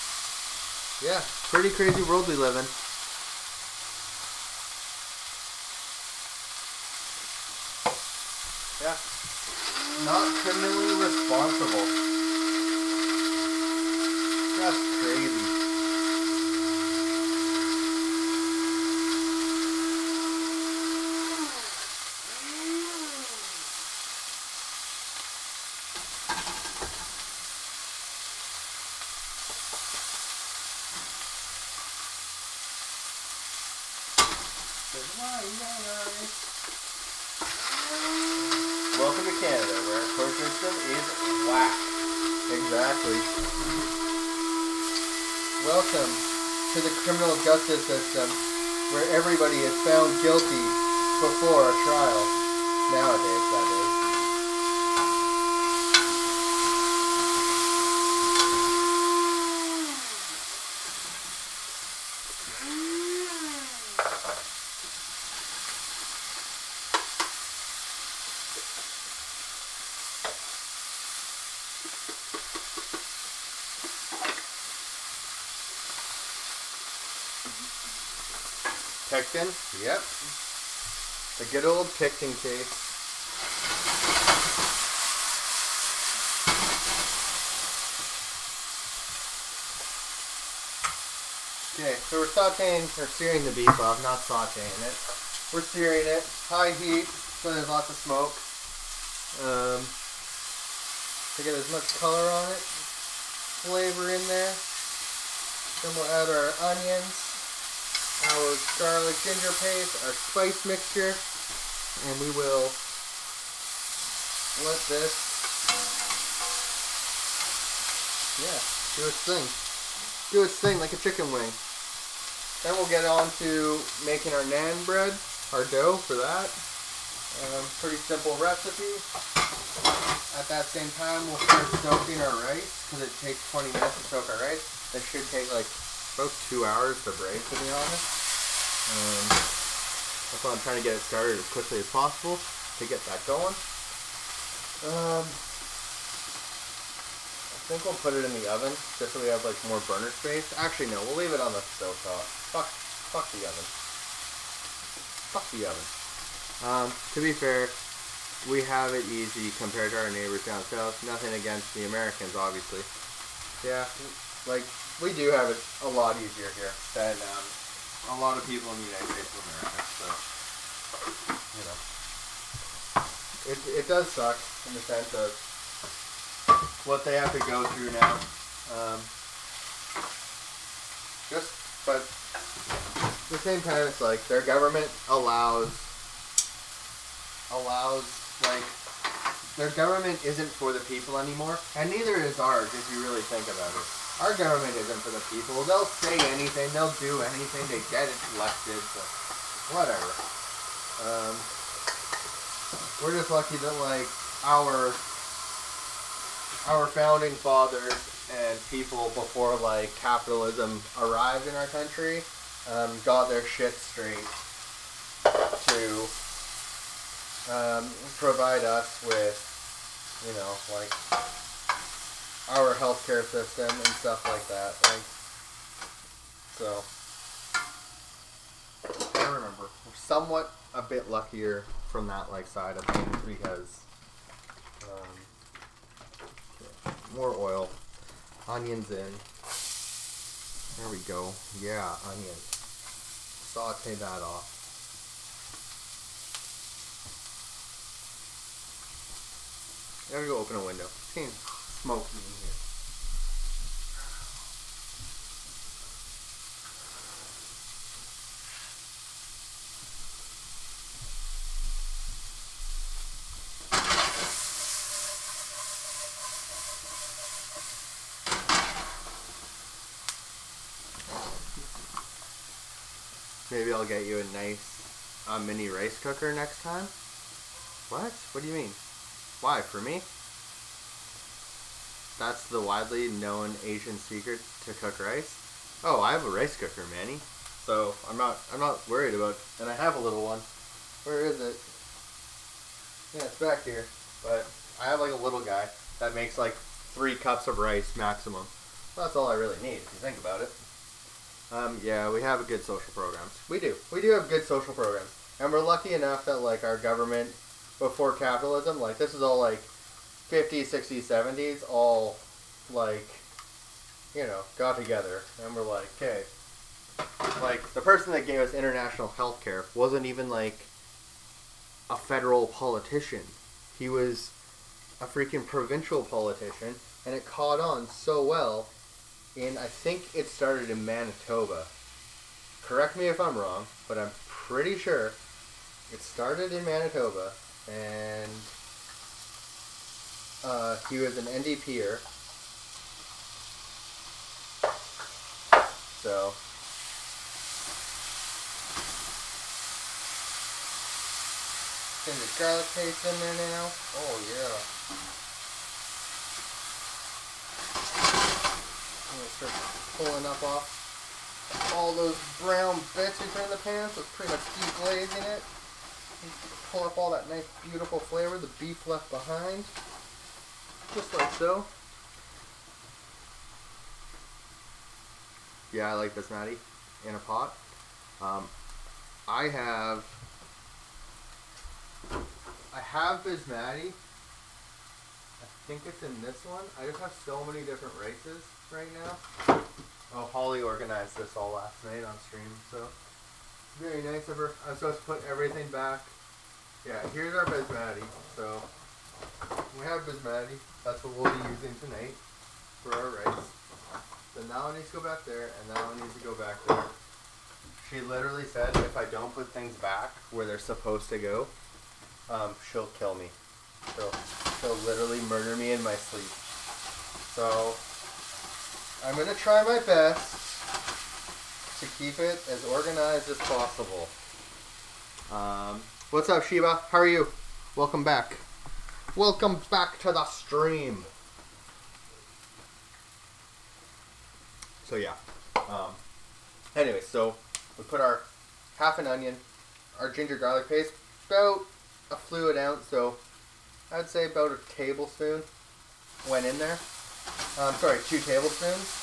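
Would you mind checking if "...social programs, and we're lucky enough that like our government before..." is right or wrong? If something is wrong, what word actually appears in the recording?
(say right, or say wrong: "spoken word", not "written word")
right.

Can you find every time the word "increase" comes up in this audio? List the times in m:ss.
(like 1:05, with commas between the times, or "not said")
not said.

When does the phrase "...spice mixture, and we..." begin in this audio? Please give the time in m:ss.
1:50.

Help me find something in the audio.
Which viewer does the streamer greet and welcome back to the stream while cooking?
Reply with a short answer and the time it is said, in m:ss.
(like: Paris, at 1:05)
Sheba, at 7:06.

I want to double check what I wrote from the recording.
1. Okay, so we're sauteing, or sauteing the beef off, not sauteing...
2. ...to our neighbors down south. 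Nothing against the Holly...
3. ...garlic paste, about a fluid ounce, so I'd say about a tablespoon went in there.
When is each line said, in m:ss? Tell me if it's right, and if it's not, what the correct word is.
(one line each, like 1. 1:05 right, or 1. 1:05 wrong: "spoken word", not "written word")
1. 1:31 wrong: "searing", not "sauteing"
2. 2:39 wrong: "Americans", not "Holly"
3. 7:20 right.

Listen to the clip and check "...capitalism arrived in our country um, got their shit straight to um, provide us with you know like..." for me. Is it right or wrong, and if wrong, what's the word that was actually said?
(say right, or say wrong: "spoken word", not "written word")
right.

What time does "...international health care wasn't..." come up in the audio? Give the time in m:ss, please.
5:18.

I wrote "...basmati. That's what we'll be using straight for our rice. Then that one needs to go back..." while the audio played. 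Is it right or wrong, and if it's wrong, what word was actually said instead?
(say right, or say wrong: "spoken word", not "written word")
wrong: "tonight", not "straight".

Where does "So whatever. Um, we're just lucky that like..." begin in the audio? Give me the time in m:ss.
3:18.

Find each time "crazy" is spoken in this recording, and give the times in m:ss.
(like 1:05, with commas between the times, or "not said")
0:01, 0:15.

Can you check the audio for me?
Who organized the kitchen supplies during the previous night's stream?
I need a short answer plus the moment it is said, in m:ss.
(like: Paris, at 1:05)
Holly, at 6:30.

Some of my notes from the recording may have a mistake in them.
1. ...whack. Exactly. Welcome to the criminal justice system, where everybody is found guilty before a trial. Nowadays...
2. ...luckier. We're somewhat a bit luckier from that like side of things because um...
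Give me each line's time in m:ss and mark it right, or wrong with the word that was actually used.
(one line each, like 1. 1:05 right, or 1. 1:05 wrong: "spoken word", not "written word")
1. 0:41 right
2. 3:49 wrong: "remember", not "luckier".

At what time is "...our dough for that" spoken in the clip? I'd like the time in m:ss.
2:05.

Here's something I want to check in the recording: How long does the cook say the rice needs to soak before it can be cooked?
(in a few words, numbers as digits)
20 minutes.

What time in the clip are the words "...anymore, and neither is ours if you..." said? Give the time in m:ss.
3:11.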